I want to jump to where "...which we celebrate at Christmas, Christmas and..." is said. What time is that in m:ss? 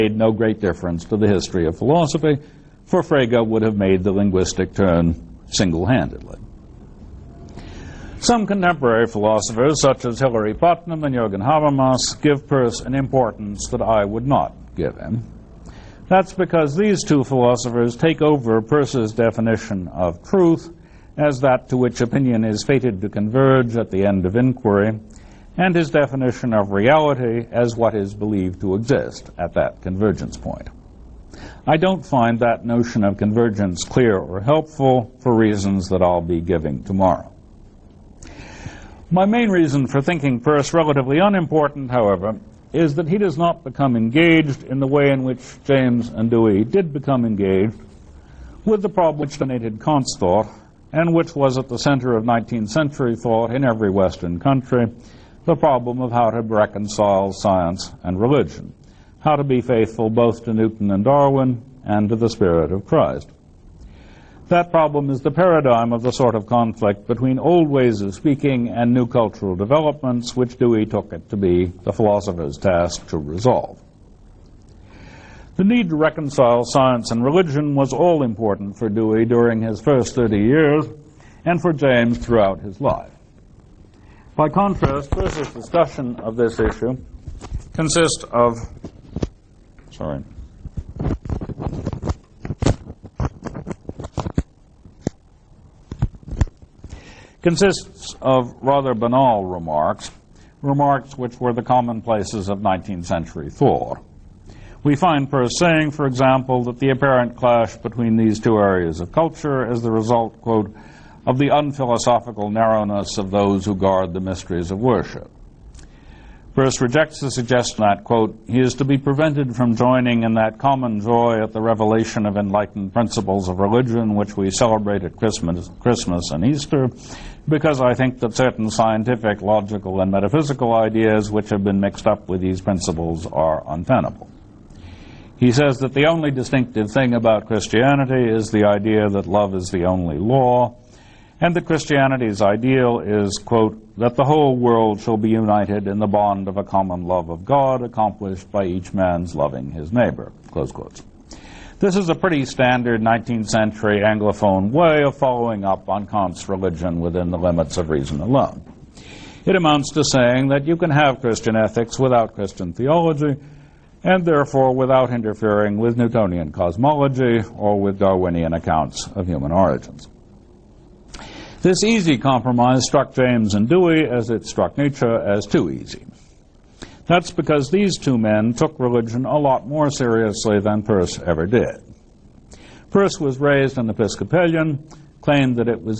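2:04.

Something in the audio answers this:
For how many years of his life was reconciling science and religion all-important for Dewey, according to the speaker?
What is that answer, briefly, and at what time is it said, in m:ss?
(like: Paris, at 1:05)
30, at 1:20.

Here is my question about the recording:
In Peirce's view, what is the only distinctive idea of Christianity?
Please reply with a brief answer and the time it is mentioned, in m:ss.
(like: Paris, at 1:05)
love is the only law, at 2:19.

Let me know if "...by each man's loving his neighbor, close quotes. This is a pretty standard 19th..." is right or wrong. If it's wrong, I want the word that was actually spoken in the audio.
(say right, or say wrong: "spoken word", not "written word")
right.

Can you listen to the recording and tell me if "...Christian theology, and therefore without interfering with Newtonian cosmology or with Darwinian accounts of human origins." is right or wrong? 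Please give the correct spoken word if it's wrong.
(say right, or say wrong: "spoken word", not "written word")
right.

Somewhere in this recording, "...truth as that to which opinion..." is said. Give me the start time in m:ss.
0:20.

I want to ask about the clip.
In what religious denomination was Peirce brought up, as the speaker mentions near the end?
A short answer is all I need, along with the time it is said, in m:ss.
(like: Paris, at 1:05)
Episcopalian, at 3:03.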